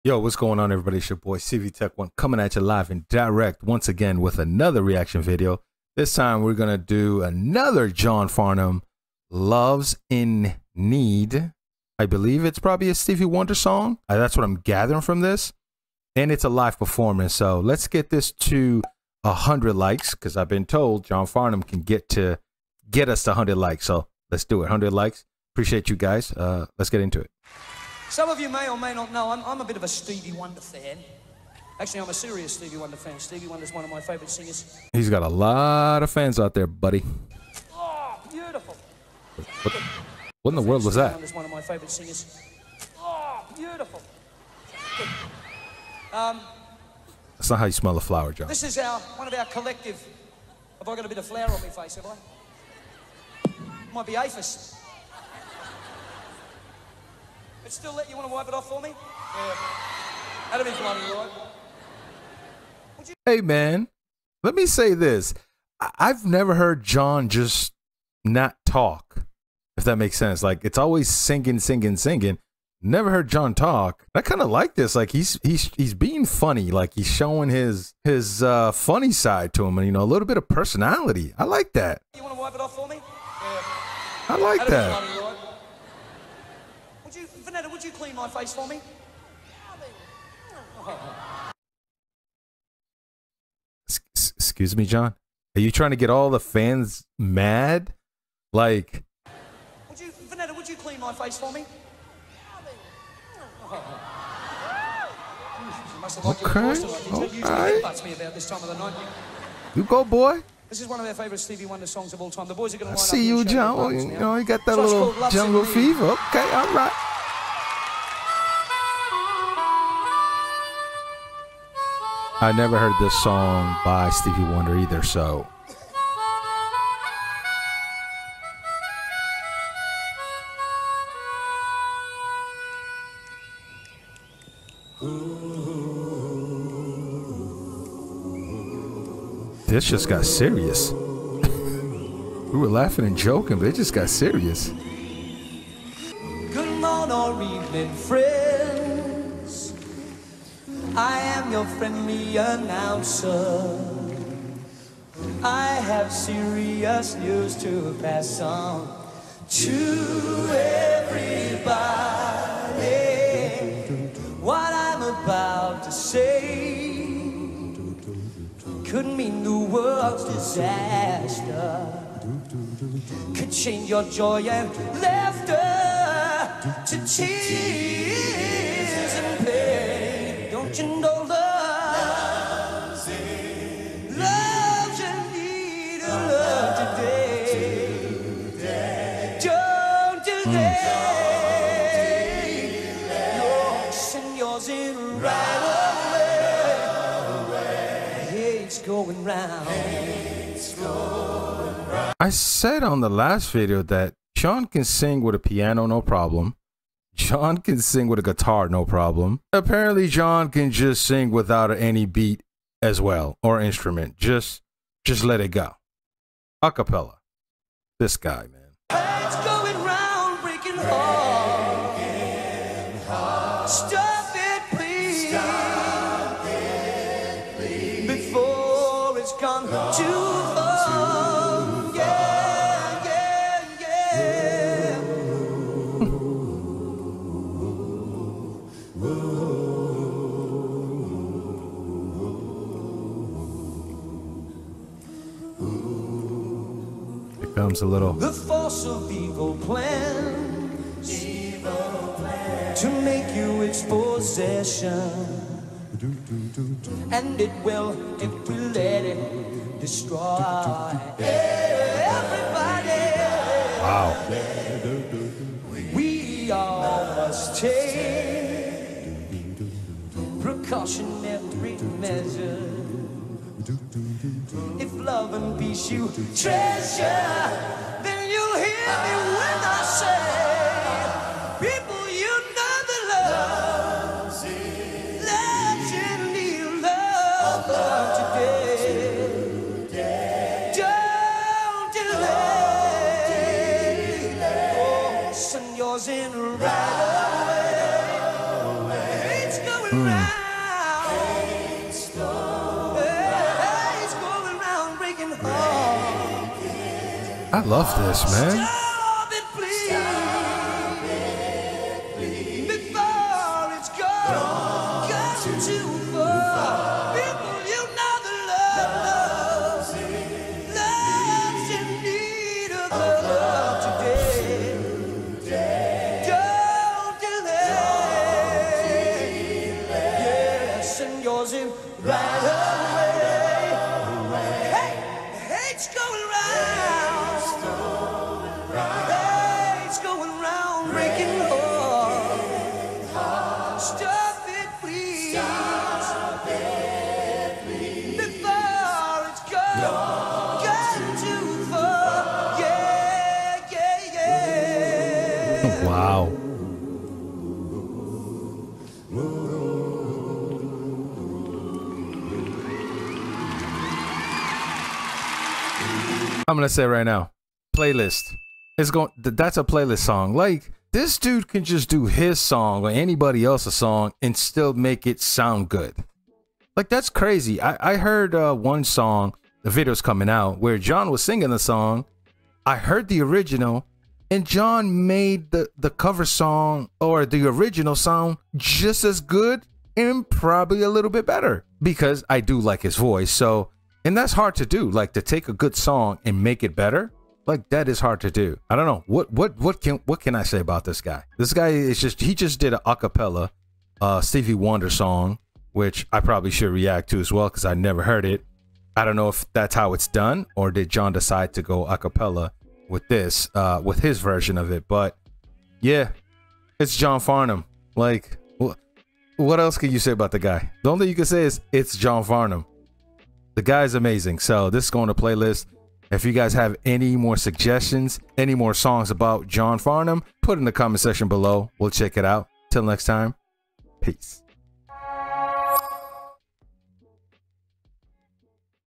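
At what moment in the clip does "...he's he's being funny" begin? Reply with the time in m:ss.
1:15.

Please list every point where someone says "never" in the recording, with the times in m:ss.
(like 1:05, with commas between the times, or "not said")
1:06, 1:12, 2:02, 6:47.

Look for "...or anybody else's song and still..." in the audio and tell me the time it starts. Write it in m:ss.
6:12.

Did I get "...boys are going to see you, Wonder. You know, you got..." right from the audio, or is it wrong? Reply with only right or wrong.
wrong.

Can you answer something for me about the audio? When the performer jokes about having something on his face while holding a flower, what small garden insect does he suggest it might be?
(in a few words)
aphis.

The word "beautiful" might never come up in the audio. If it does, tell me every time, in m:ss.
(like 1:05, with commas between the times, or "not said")
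0:38, 0:43.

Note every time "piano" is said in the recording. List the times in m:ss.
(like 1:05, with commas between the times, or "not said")
3:25.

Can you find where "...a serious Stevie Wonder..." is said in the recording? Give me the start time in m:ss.
0:32.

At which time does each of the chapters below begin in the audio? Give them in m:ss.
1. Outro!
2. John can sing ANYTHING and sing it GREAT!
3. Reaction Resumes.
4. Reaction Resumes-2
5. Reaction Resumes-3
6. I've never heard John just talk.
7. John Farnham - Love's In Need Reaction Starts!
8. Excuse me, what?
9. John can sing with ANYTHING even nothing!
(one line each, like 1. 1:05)
1. 6:55
2. 6:06
3. 1:20
4. 1:40
5. 3:39
6. 1:03
7. 0:27
8. 1:30
9. 3:21.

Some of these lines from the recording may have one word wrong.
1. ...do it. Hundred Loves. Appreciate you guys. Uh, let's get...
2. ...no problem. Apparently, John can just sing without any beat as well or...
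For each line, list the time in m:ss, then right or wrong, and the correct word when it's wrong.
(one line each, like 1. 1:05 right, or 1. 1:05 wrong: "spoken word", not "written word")
1. 0:24 wrong: "likes", not "Loves"
2. 3:28 right.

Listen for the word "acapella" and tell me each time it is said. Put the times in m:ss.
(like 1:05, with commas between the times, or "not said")
3:36, 6:42, 6:51.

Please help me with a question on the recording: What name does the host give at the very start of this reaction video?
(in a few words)
CV Tech One.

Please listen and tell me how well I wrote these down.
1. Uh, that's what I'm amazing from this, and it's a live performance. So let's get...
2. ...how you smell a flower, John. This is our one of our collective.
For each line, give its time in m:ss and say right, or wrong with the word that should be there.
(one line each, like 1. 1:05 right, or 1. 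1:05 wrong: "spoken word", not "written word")
1. 0:14 wrong: "gathering", not "amazing"
2. 0:47 right.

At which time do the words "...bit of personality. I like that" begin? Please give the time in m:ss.
1:20.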